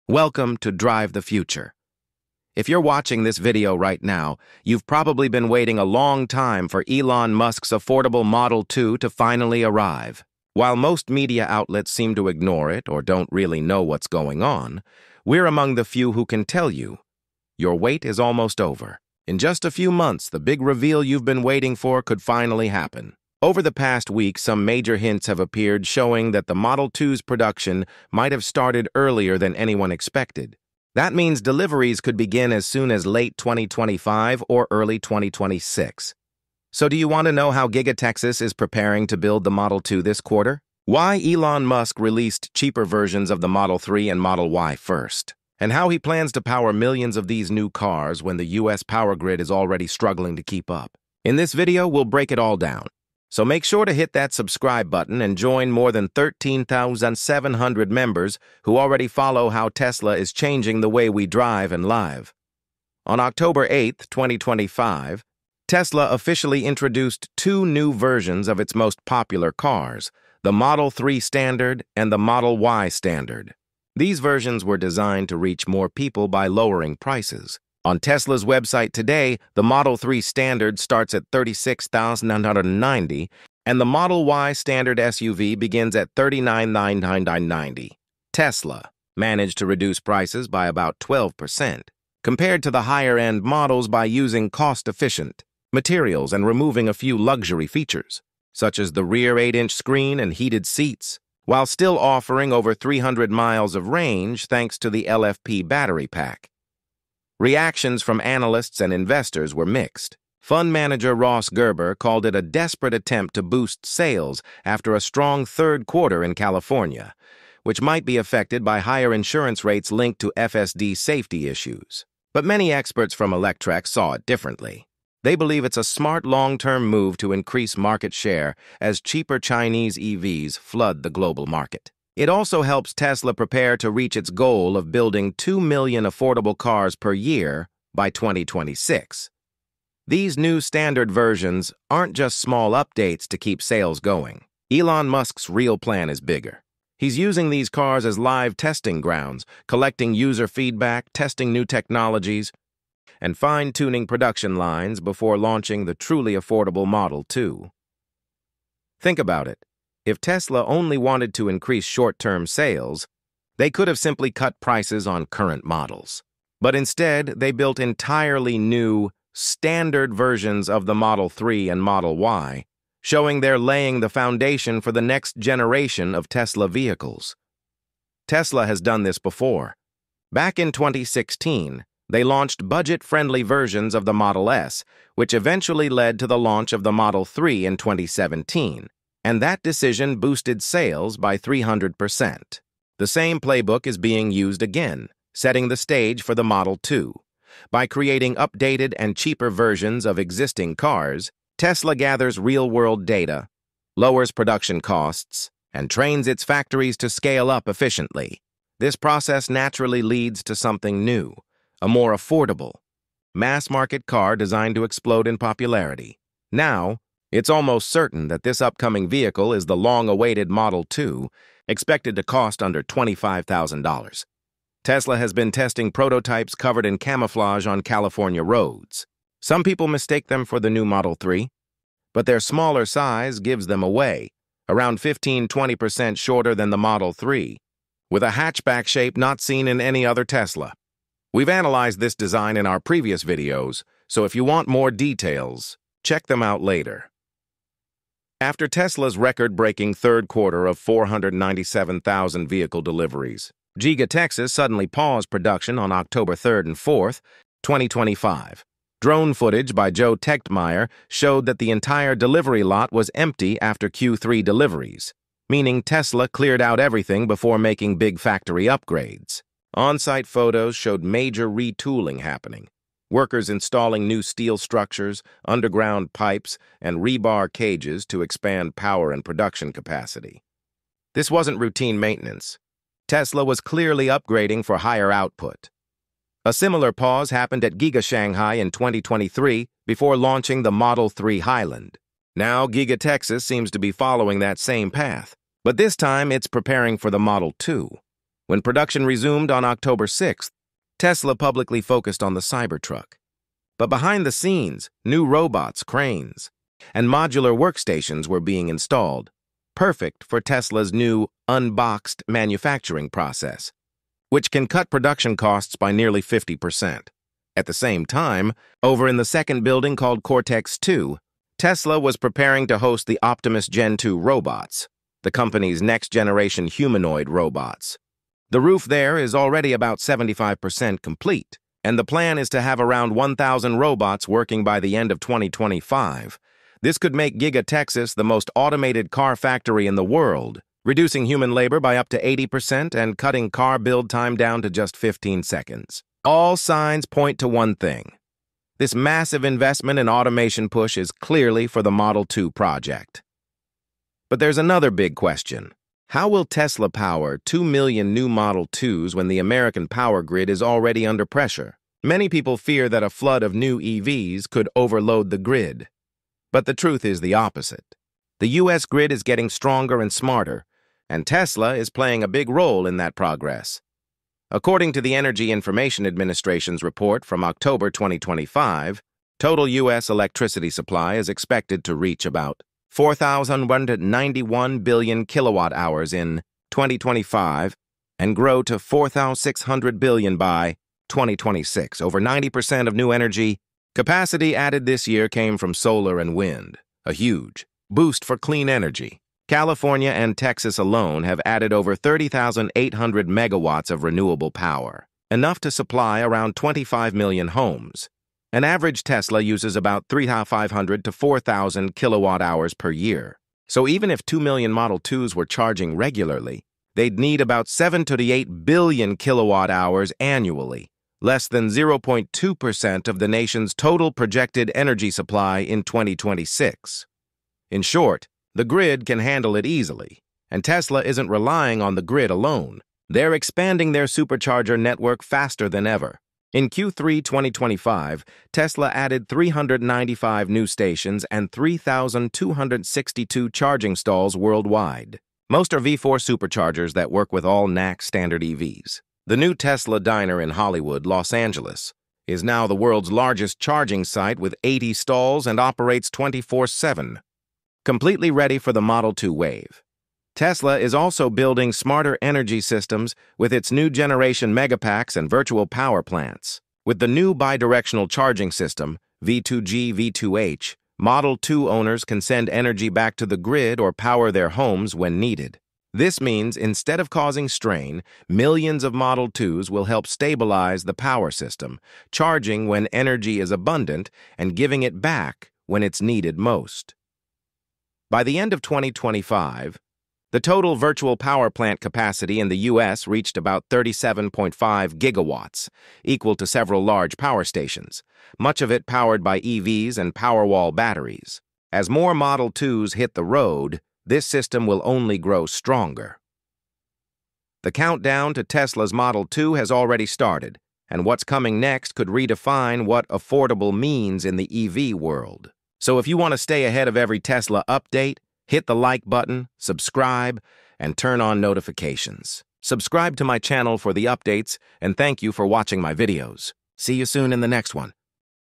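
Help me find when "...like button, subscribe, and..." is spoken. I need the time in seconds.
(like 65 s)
518 s.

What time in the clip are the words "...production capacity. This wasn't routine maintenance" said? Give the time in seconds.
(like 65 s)
279 s.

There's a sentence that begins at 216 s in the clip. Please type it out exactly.
Now, it's almost certain that this upcoming vehicle is the long-awaited Model 2, expected to cost under $25,000.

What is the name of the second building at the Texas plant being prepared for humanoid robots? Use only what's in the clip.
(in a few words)
Cortex 2.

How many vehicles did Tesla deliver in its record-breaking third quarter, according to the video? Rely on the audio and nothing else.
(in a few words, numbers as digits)
497,000.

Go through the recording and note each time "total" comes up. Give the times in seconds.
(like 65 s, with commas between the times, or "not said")
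379 s, 423 s, 490 s.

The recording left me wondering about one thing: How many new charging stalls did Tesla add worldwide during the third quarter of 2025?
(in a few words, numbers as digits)
3,262.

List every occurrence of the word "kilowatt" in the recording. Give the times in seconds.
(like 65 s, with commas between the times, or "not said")
385 s, 411 s, 419 s.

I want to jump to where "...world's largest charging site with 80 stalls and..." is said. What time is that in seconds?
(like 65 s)
452 s.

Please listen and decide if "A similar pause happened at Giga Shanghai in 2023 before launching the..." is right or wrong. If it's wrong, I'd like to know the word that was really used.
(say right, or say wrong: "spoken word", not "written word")
right.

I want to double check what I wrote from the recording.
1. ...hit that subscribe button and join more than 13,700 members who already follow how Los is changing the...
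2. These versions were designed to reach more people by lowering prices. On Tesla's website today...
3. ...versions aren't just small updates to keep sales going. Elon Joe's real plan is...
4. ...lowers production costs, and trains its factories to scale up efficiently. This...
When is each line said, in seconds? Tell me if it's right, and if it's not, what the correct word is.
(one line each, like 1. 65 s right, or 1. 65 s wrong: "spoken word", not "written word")
1. 53 s wrong: "Tesla", not "Los"
2. 73 s right
3. 141 s wrong: "Musk", not "Joe"
4. 203 s right.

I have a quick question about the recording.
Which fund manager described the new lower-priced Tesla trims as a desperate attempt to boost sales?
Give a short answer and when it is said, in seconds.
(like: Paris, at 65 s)
Ross Gerber, at 111 s.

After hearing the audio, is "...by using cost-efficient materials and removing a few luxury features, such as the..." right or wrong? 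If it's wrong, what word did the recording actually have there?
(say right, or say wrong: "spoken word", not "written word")
right.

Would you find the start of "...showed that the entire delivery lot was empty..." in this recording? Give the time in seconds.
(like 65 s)
261 s.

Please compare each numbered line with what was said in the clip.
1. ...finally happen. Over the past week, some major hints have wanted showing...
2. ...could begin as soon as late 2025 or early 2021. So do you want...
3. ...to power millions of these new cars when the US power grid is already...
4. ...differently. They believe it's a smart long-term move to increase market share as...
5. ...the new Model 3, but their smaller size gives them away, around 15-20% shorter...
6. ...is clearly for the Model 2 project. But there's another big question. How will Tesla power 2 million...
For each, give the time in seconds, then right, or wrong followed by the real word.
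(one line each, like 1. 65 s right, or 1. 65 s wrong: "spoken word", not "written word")
1. 22 s wrong: "appeared", not "wanted"
2. 32 s wrong: "2026", not "2021"
3. 46 s right
4. 124 s right
5. 230 s right
6. 350 s right.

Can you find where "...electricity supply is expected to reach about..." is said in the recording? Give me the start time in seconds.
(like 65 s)
380 s.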